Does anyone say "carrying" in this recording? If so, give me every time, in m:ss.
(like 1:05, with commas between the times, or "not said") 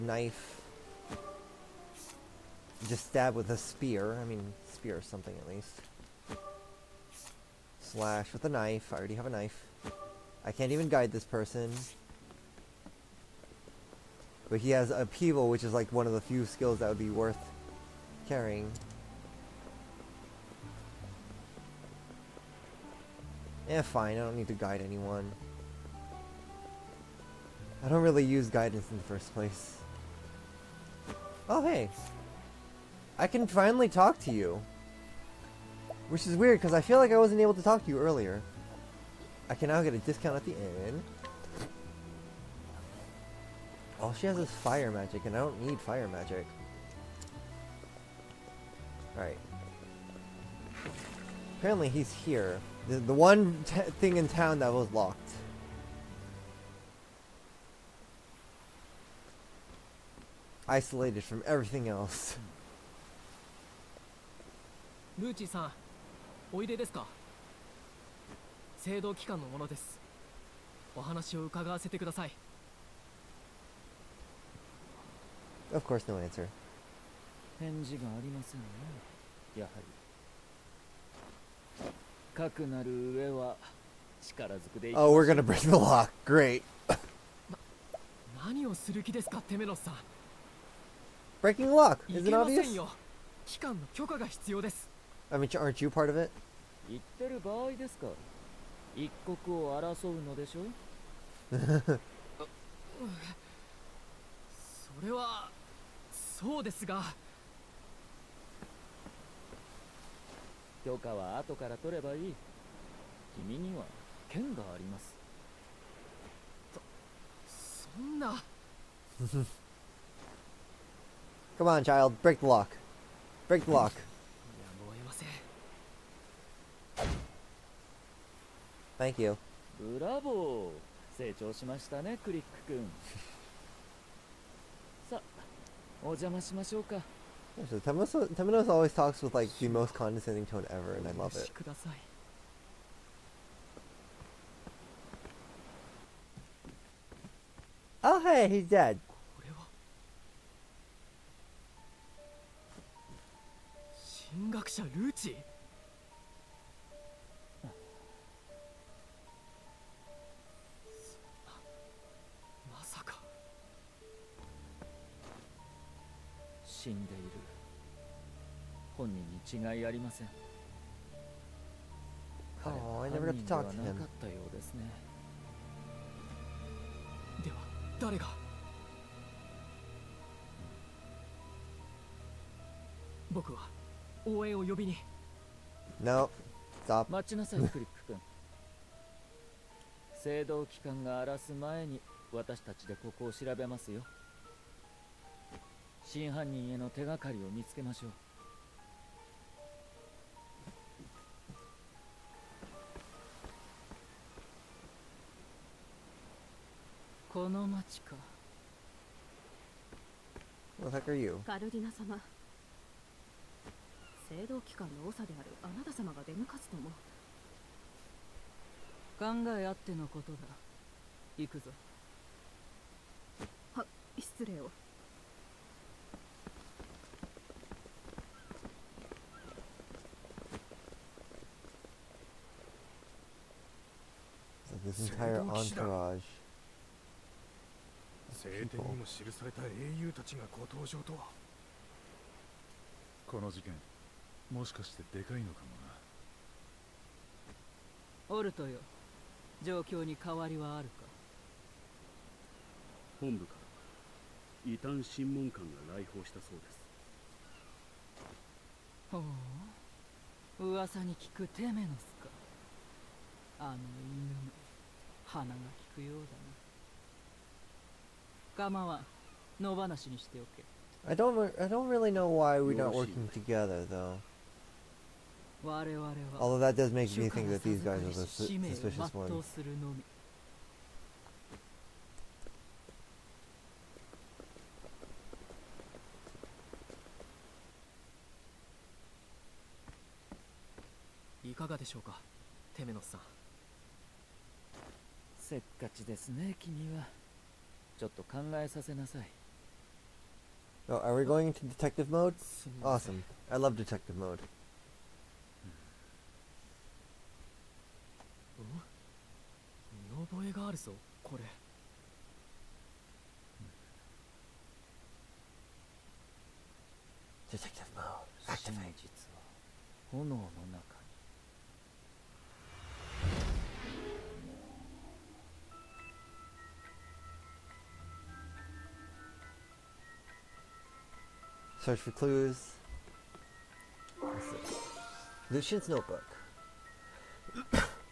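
0:18.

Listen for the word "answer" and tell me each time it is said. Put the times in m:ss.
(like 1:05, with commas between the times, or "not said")
1:16.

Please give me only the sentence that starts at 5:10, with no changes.
見 覚 え が あ る ぞ、 こ れ。 Detective mode.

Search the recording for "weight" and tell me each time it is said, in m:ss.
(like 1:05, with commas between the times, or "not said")
not said.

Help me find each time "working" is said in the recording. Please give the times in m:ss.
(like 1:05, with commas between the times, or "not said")
4:32.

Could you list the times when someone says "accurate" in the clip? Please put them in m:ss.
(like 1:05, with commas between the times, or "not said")
not said.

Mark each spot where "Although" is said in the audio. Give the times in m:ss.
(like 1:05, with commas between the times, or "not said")
4:36.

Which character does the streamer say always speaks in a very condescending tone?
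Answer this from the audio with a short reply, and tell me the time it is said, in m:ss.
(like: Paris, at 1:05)
Temenos, at 2:18.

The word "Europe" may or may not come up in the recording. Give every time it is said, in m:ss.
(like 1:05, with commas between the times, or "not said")
not said.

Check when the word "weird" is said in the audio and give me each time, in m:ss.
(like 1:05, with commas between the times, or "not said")
0:36.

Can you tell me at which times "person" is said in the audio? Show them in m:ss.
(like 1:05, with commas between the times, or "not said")
0:11.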